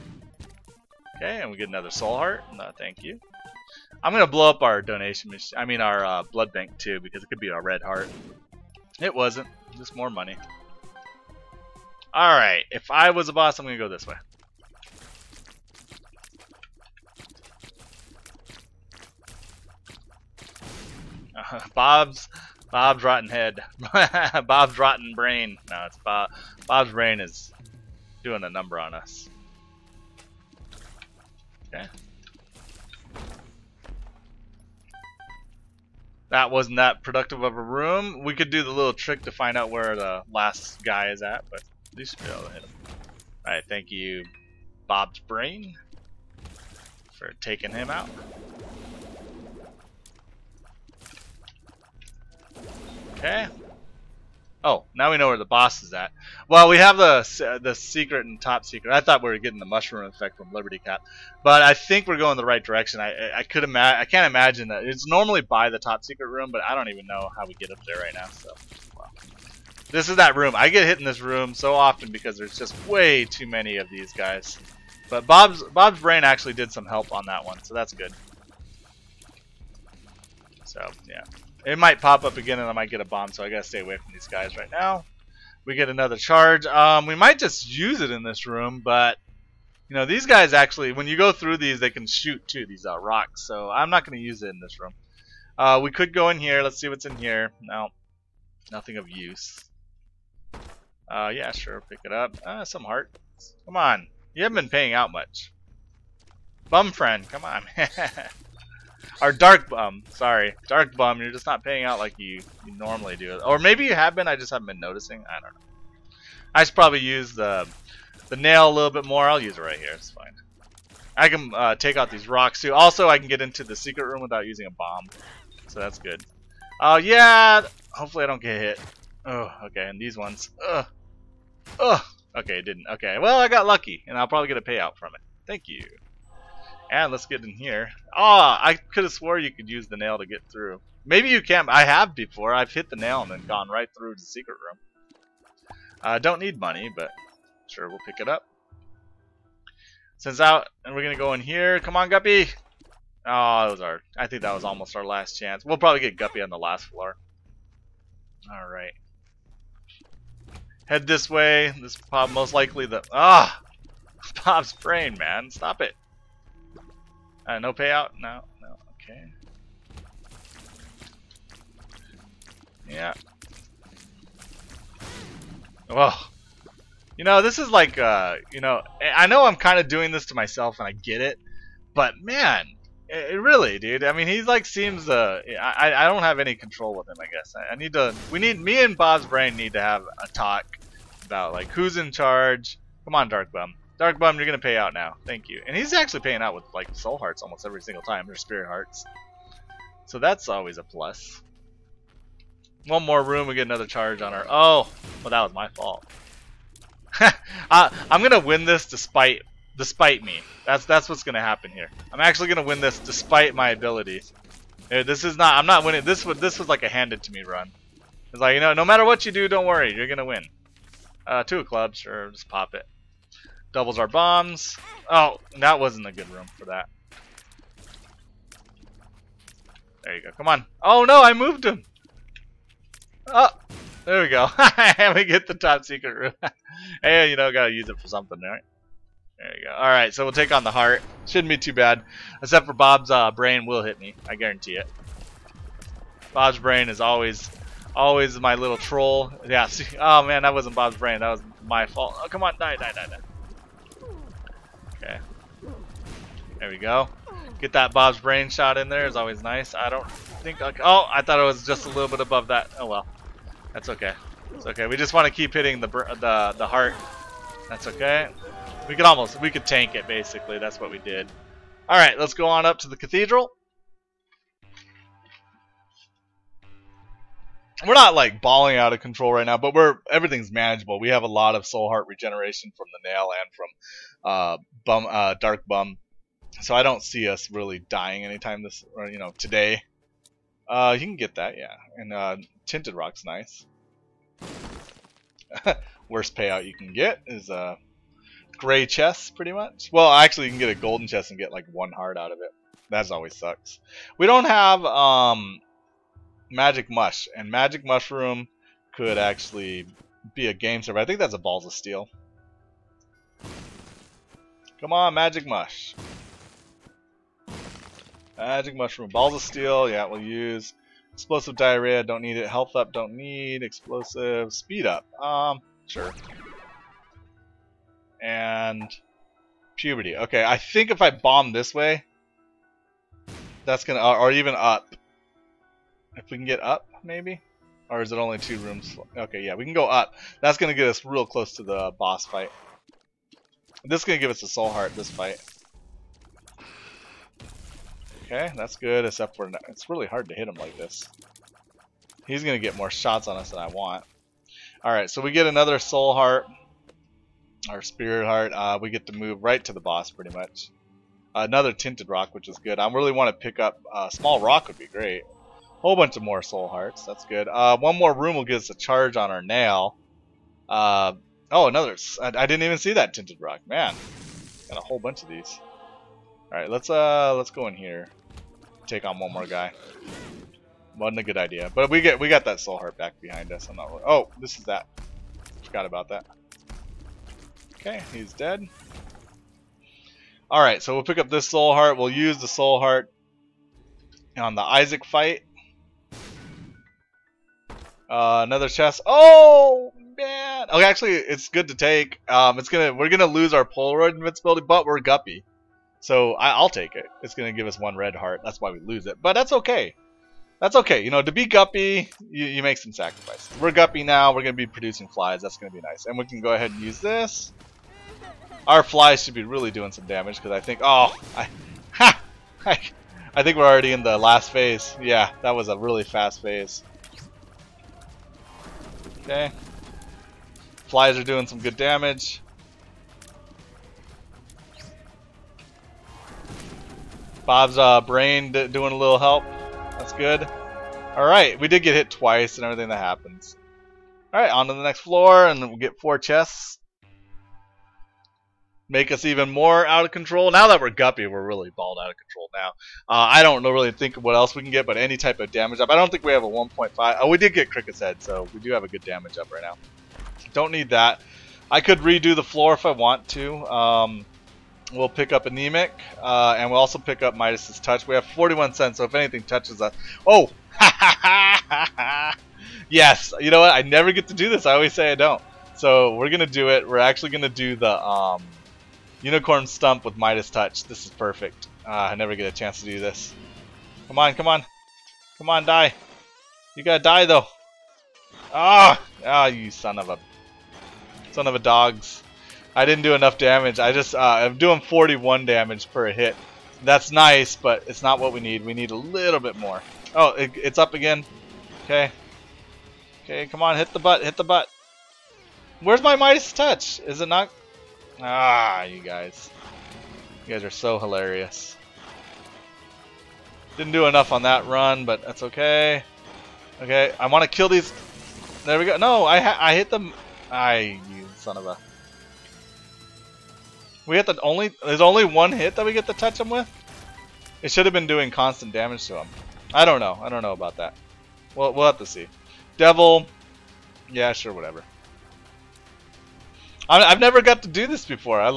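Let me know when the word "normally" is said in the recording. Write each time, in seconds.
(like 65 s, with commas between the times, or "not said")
65 s, 112 s.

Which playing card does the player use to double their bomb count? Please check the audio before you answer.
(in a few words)
Two of clubs.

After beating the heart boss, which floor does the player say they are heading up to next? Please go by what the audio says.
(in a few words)
The Cathedral.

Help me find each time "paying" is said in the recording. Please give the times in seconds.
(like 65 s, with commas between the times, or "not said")
104 s, 111 s, 196 s.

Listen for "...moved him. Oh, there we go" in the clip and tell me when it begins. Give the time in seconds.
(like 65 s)
231 s.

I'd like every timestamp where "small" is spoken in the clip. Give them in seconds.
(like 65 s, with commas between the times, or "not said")
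364 s.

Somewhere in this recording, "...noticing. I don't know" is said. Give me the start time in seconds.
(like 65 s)
114 s.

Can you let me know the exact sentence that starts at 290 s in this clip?
Uh, you can get that, yeah.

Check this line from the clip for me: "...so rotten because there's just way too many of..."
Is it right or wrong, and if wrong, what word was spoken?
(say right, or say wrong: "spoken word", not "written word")
wrong: "often", not "rotten".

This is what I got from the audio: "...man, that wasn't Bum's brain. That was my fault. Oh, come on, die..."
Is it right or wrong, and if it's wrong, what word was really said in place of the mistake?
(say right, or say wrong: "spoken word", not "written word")
wrong: "Bob", not "Bum".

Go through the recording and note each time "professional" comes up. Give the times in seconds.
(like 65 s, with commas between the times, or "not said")
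not said.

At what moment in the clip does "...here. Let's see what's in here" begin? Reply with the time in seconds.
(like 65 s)
96 s.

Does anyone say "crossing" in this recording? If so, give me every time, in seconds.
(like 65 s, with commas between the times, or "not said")
not said.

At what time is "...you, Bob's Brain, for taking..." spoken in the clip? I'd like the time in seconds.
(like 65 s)
43 s.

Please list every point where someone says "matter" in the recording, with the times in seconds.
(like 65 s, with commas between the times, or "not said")
218 s.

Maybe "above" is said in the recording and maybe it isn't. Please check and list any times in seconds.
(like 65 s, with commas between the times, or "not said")
262 s.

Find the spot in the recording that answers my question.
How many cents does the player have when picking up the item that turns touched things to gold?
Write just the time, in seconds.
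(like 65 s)
468 s.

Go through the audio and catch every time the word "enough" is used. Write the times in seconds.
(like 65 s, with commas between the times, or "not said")
493 s, 514 s.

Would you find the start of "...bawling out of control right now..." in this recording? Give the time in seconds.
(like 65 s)
278 s.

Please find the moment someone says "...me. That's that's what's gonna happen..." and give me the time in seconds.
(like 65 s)
210 s.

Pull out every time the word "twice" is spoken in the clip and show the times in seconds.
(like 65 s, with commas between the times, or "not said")
442 s.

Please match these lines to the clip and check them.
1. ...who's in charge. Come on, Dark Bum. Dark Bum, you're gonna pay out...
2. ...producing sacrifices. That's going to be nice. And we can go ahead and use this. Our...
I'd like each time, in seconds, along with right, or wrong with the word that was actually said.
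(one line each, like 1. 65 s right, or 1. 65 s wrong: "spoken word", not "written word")
1. 191 s right
2. 414 s wrong: "flies", not "sacrifices".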